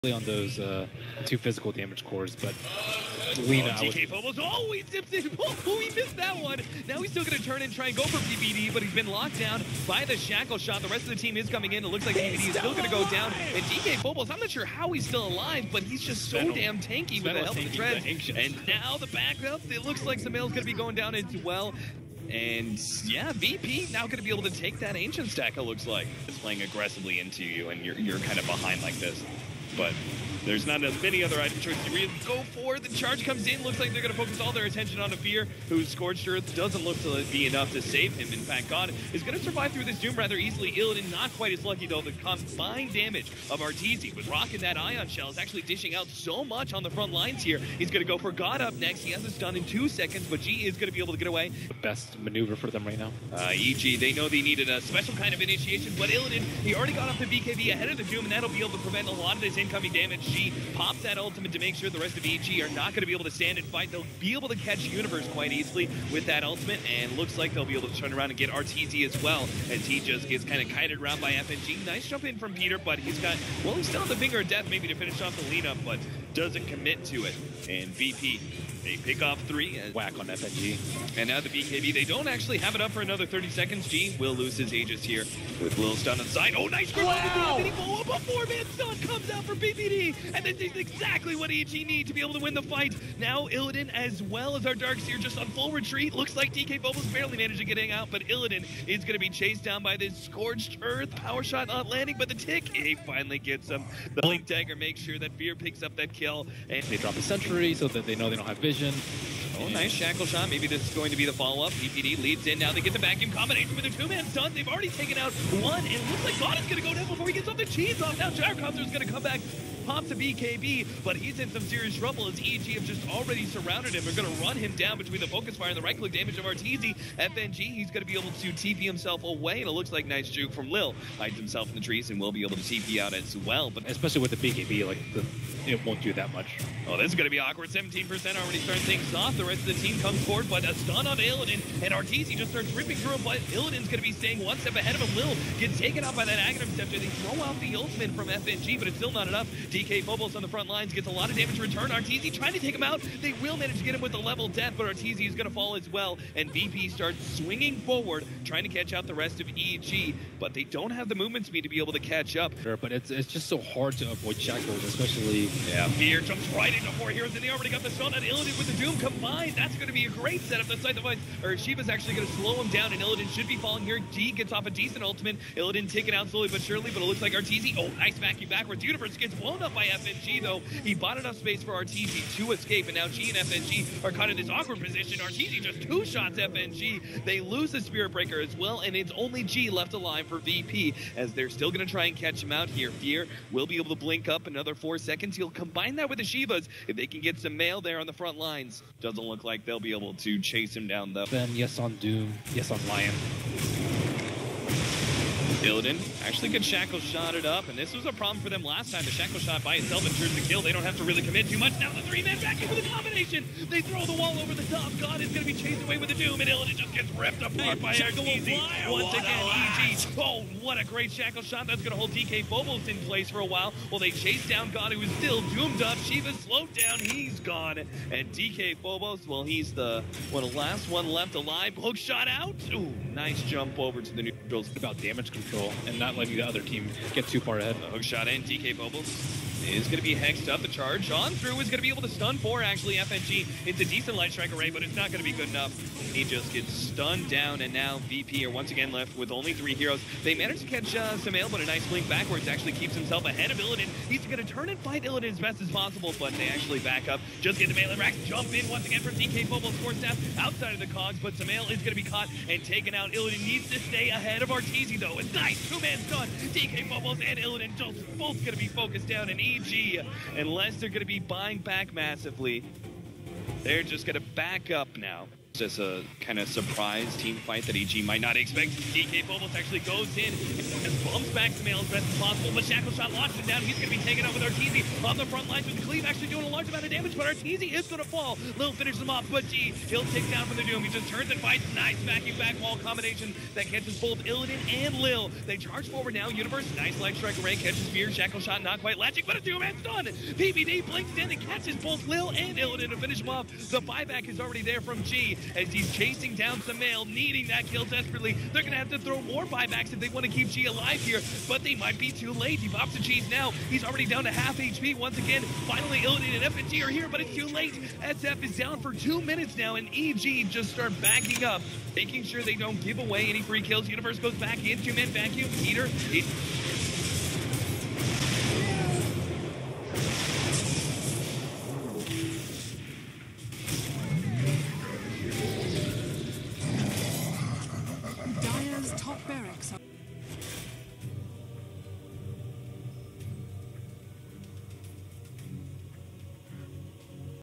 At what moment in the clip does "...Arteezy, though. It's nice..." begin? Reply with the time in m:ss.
4:24.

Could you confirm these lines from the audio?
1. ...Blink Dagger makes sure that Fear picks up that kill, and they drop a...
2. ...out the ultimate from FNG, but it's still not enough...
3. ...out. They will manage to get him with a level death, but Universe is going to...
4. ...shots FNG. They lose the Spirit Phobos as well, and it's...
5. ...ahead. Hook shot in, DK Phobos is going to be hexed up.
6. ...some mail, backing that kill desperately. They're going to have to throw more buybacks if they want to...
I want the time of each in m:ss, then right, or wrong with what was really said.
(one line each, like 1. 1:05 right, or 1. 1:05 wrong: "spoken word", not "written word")
1. 1:44 right
2. 2:27 right
3. 2:32 wrong: "Arteezy", not "Universe"
4. 3:06 wrong: "Breaker", not "Phobos"
5. 3:57 right
6. 5:06 wrong: "needing", not "backing".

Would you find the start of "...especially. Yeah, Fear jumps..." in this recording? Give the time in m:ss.
2:44.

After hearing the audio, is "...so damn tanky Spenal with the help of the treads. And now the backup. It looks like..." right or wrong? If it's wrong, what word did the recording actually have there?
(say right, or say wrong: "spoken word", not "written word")
right.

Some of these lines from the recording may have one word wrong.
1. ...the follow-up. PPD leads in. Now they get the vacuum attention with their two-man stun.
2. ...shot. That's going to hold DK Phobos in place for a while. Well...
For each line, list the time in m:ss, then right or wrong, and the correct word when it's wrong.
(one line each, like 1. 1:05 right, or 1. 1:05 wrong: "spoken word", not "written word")
1. 1:51 wrong: "combination", not "attention"
2. 3:41 right.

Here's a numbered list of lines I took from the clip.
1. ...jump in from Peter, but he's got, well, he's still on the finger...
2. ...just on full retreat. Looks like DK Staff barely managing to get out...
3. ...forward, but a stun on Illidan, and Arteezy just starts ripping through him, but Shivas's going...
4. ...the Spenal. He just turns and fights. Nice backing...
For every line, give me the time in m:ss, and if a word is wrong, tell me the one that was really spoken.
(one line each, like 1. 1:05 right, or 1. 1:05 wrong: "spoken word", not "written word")
1. 1:12 right
2. 1:35 wrong: "Phobos", not "Staff"
3. 2:20 wrong: "Illidan", not "Shivas"
4. 4:50 wrong: "Doom", not "Spenal".